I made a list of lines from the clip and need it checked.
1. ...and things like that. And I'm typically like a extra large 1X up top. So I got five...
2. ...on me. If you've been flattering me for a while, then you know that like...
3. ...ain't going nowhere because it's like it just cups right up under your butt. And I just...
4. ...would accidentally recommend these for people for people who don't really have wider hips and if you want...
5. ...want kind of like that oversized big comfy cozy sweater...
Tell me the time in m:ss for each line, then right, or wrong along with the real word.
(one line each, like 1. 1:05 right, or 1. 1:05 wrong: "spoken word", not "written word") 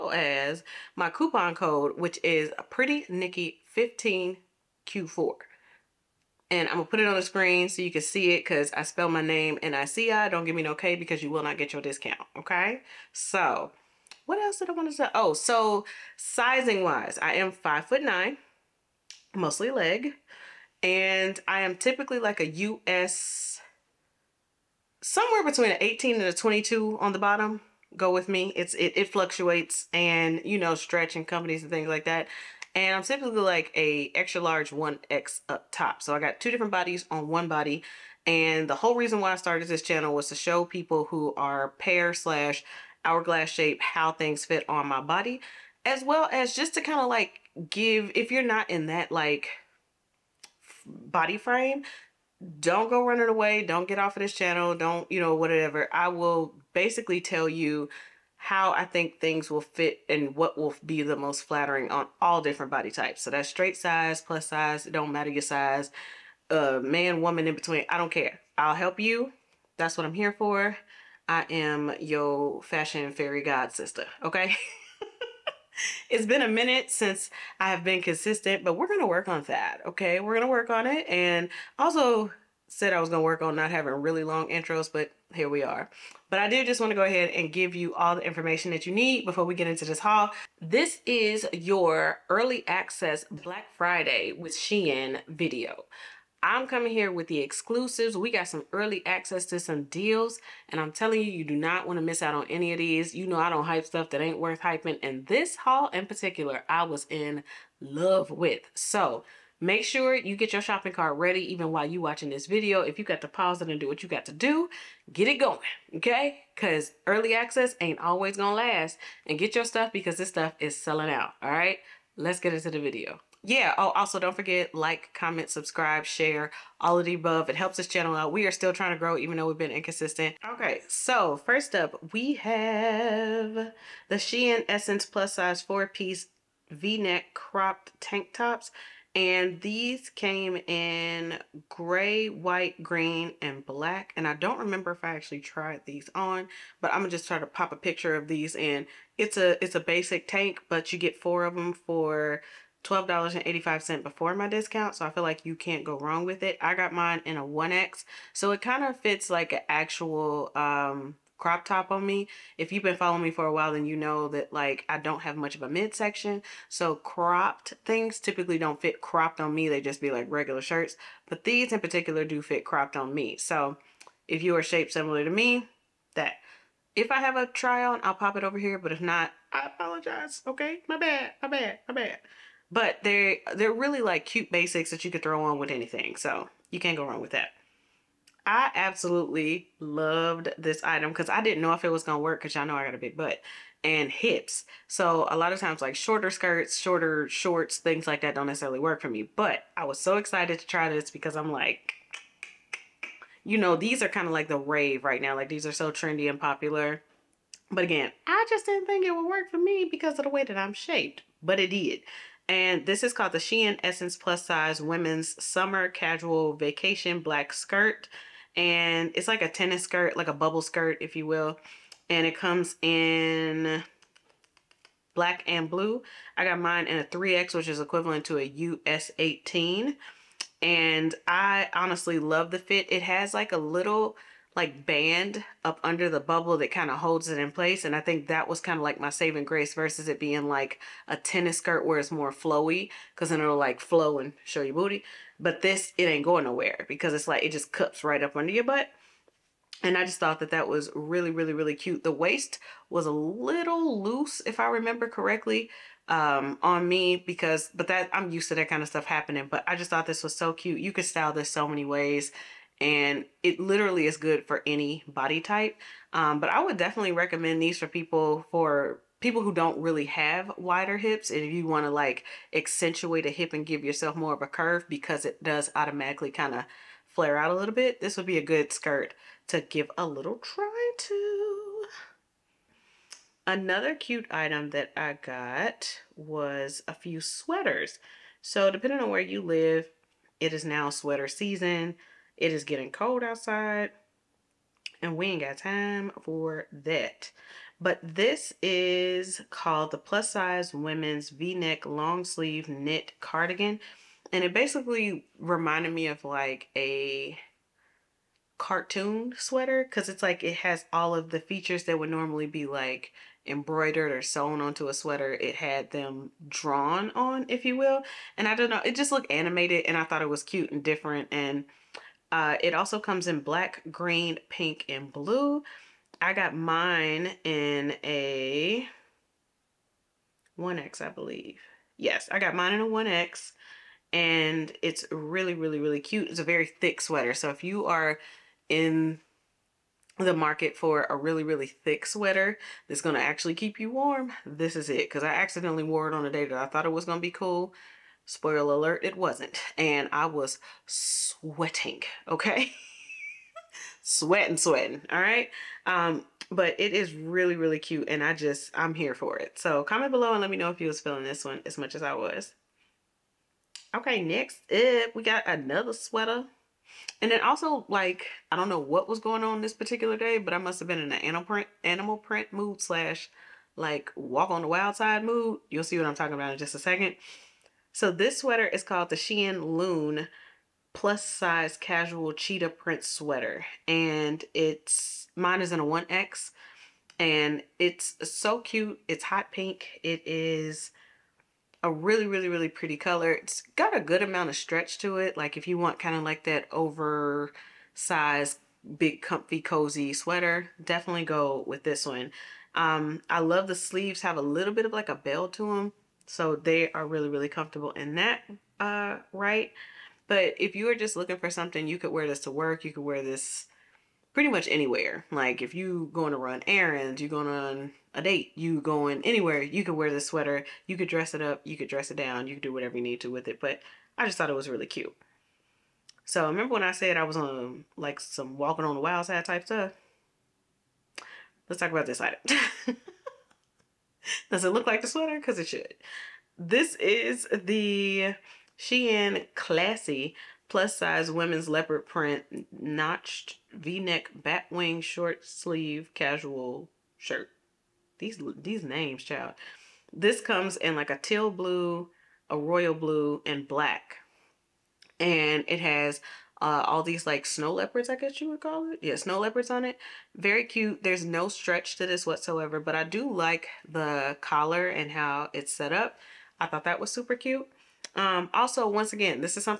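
1. 0:31 wrong: "two", not "five"
2. 2:41 wrong: "following", not "flattering"
3. 4:06 right
4. 4:26 wrong: "definitely", not "accidentally"
5. 6:35 right.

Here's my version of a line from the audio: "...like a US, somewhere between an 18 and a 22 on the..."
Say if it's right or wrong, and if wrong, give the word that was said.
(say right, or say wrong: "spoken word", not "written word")
right.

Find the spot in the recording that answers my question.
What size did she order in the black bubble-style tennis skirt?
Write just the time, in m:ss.
3:47.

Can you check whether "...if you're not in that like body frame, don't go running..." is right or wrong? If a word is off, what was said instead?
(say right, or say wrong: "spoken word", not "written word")
right.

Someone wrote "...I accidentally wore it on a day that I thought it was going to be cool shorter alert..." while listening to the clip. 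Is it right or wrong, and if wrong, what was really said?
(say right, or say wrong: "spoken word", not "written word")
wrong: "spoiler", not "shorter".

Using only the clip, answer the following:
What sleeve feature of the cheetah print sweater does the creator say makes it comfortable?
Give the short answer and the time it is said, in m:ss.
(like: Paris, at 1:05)
A bell, at 6:45.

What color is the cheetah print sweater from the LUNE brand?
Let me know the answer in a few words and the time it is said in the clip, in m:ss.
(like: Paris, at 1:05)
Hot pink, at 6:29.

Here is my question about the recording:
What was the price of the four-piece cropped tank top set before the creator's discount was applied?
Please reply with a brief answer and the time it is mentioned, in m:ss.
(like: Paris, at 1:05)
$12.85, at 2:32.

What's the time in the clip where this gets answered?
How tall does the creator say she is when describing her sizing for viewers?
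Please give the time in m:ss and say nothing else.
0:17.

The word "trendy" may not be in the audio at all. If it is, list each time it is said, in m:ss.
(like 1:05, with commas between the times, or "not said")
3:25.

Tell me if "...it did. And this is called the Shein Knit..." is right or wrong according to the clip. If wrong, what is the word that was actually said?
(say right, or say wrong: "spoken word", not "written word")
wrong: "Essnce", not "Knit".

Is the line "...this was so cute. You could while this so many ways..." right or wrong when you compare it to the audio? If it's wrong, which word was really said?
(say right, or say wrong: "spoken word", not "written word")
wrong: "style", not "while".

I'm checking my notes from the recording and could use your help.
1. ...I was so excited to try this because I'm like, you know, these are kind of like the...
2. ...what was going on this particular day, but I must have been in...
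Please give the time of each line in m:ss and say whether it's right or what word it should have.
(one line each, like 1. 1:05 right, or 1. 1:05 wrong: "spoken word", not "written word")
1. 3:19 right
2. 6:08 right.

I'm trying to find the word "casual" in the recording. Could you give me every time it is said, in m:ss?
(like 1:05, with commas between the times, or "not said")
3:35, 6:21, 7:26.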